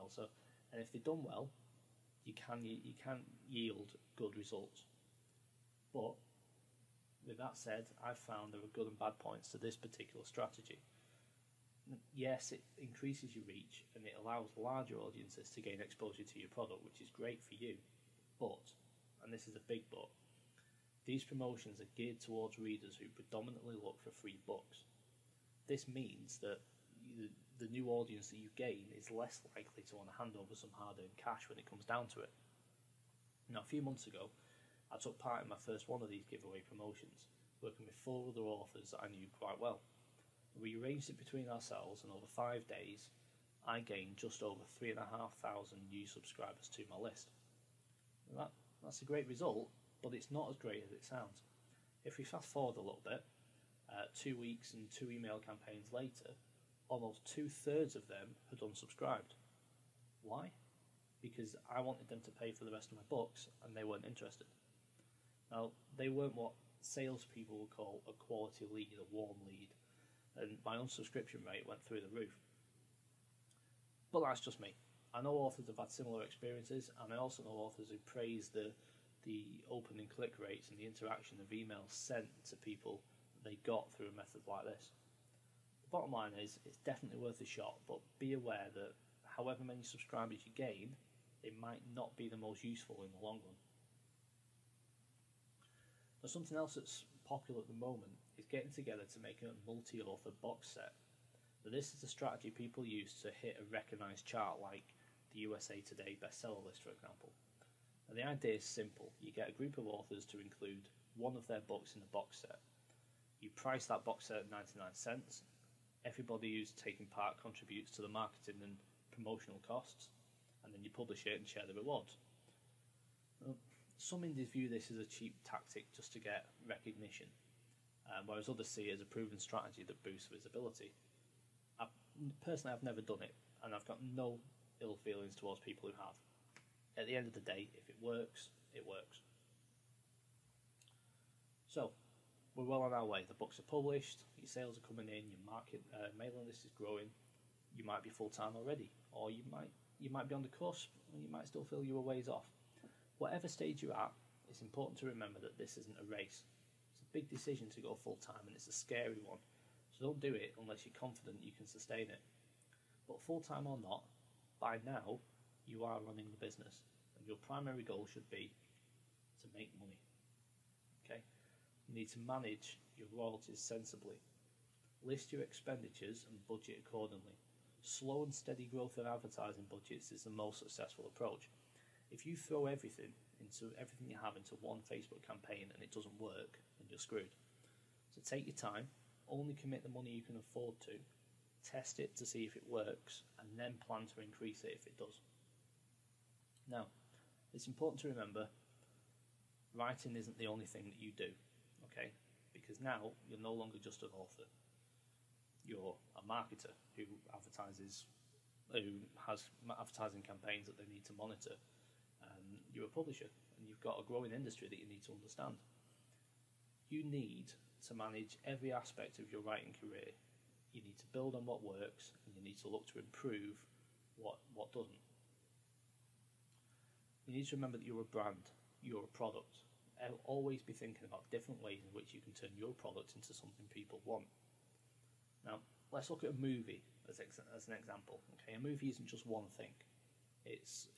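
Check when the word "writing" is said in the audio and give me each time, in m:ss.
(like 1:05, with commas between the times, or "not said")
3:19, 3:39.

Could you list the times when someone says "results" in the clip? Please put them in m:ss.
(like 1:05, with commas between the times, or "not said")
0:04, 0:49.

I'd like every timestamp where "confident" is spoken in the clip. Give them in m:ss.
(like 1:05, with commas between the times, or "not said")
2:40.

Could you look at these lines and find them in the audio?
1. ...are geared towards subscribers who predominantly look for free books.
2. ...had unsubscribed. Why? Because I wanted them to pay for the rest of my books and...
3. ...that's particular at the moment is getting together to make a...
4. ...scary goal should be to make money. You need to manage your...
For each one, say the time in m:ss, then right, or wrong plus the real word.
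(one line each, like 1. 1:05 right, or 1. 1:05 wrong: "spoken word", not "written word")
1. 0:21 wrong: "readers", not "subscribers"
2. 0:58 right
3. 1:36 wrong: "popular", not "particular"
4. 2:47 wrong: "primary", not "scary".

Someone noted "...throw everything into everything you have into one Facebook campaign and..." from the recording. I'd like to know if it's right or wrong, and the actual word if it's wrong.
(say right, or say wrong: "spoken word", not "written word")
right.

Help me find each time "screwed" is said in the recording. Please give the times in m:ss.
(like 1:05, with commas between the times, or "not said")
3:06.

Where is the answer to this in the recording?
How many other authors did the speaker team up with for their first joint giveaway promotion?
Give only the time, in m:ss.
0:38.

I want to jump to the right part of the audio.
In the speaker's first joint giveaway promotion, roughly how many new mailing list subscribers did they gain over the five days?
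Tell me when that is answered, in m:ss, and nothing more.
0:44.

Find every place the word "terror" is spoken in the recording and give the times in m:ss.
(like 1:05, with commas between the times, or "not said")
not said.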